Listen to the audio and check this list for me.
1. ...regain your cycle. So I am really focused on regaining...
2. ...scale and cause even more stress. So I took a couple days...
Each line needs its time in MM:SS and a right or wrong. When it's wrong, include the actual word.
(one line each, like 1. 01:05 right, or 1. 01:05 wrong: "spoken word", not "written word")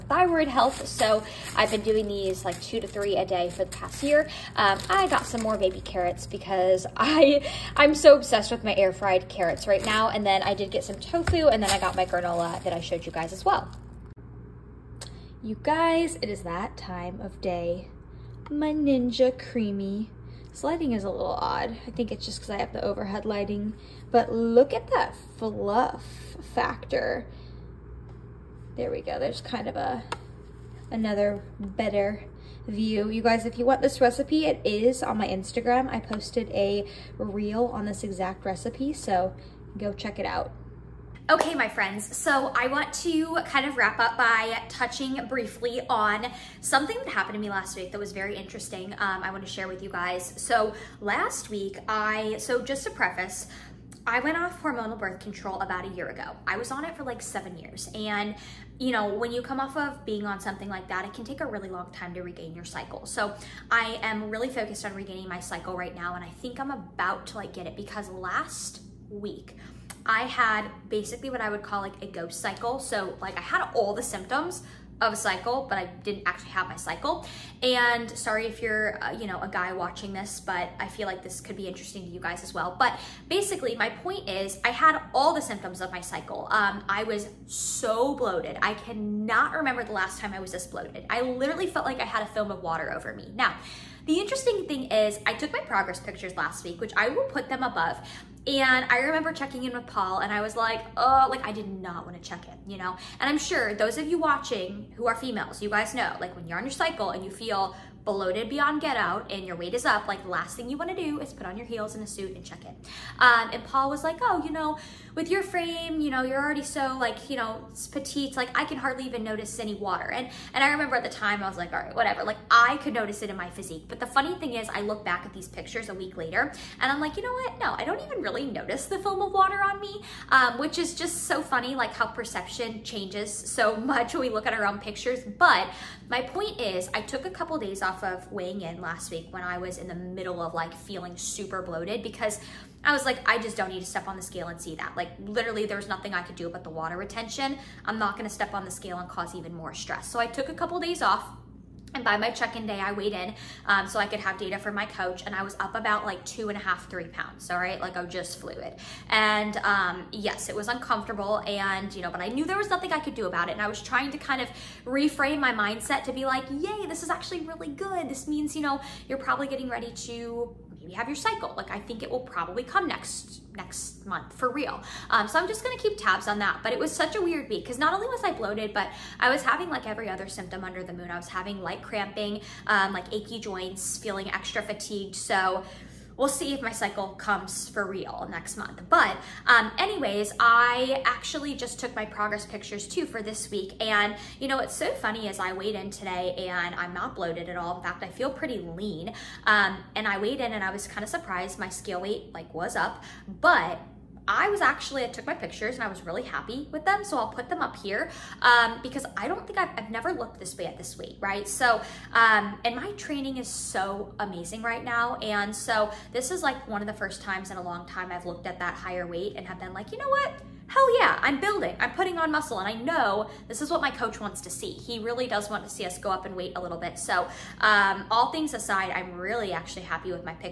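1. 01:02 right
2. 02:28 right.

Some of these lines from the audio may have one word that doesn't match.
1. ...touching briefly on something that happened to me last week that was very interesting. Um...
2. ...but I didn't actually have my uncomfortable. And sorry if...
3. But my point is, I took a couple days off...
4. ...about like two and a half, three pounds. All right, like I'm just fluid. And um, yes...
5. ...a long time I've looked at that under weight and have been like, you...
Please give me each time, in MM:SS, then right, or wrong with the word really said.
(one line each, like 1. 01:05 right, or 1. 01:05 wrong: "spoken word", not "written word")
1. 00:44 right
2. 01:15 wrong: "cycle", not "uncomfortable"
3. 02:15 right
4. 02:35 right
5. 03:37 wrong: "higher", not "under".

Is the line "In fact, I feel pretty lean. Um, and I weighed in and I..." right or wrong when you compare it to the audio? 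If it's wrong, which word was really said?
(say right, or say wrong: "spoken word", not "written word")
right.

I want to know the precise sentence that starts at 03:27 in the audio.
So I'll put them up here um, because I don't think I've, I've, never looked this way at this weight, right?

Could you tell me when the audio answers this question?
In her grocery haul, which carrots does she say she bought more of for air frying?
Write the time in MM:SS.
00:05.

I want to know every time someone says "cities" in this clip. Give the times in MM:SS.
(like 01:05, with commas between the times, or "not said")
not said.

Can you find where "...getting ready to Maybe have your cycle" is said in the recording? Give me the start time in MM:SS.
02:49.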